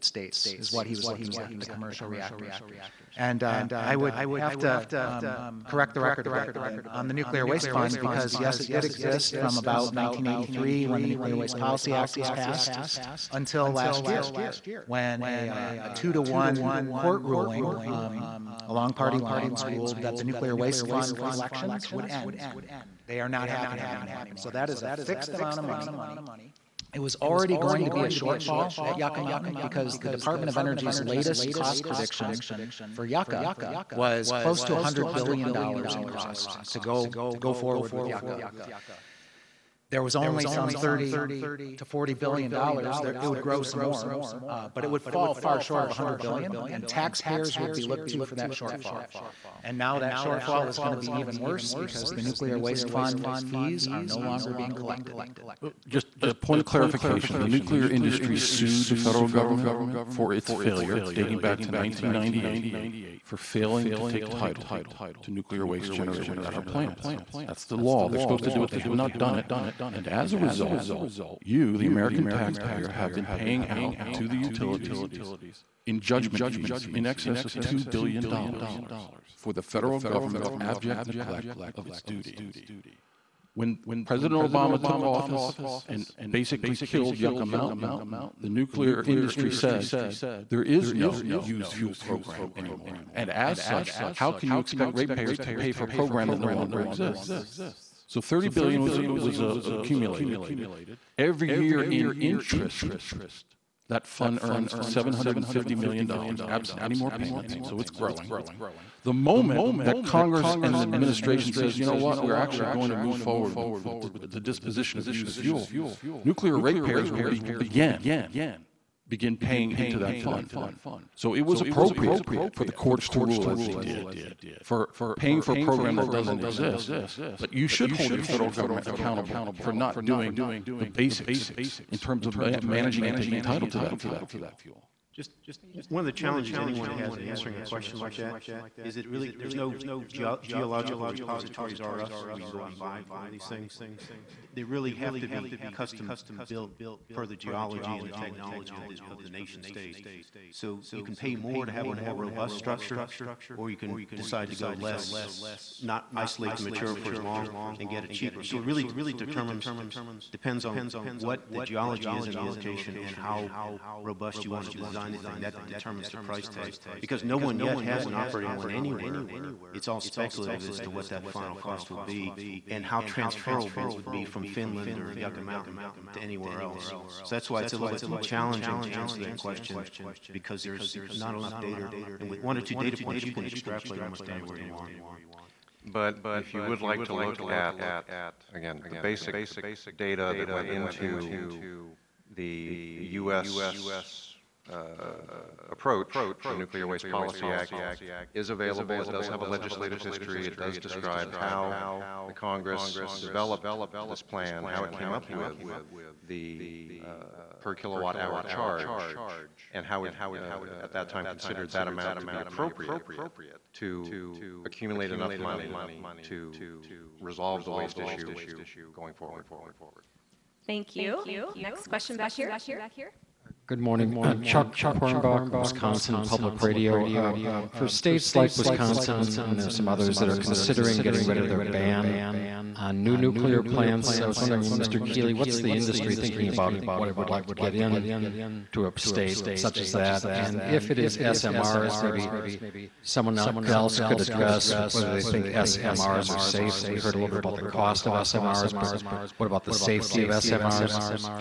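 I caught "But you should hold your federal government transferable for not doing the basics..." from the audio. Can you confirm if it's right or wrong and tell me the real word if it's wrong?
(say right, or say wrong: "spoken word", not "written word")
wrong: "accountable", not "transferable".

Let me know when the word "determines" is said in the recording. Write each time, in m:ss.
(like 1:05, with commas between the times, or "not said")
2:39, 2:45.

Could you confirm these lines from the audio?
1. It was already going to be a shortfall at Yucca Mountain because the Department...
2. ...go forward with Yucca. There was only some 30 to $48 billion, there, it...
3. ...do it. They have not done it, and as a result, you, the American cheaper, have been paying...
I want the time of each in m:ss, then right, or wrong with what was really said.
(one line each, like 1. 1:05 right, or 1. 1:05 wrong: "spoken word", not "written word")
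1. 0:26 right
2. 0:37 wrong: "40", not "48"
3. 1:08 wrong: "taxpayer", not "cheaper".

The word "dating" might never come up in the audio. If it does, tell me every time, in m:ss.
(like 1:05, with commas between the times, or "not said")
1:01.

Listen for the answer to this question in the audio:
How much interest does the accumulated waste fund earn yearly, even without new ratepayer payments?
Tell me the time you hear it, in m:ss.
1:44.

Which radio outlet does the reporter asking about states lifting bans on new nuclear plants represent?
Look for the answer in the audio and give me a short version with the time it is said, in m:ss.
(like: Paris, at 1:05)
Wisconsin Public Radio, at 3:45.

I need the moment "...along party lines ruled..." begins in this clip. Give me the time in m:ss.
0:18.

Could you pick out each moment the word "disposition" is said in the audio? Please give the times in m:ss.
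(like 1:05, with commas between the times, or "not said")
1:54.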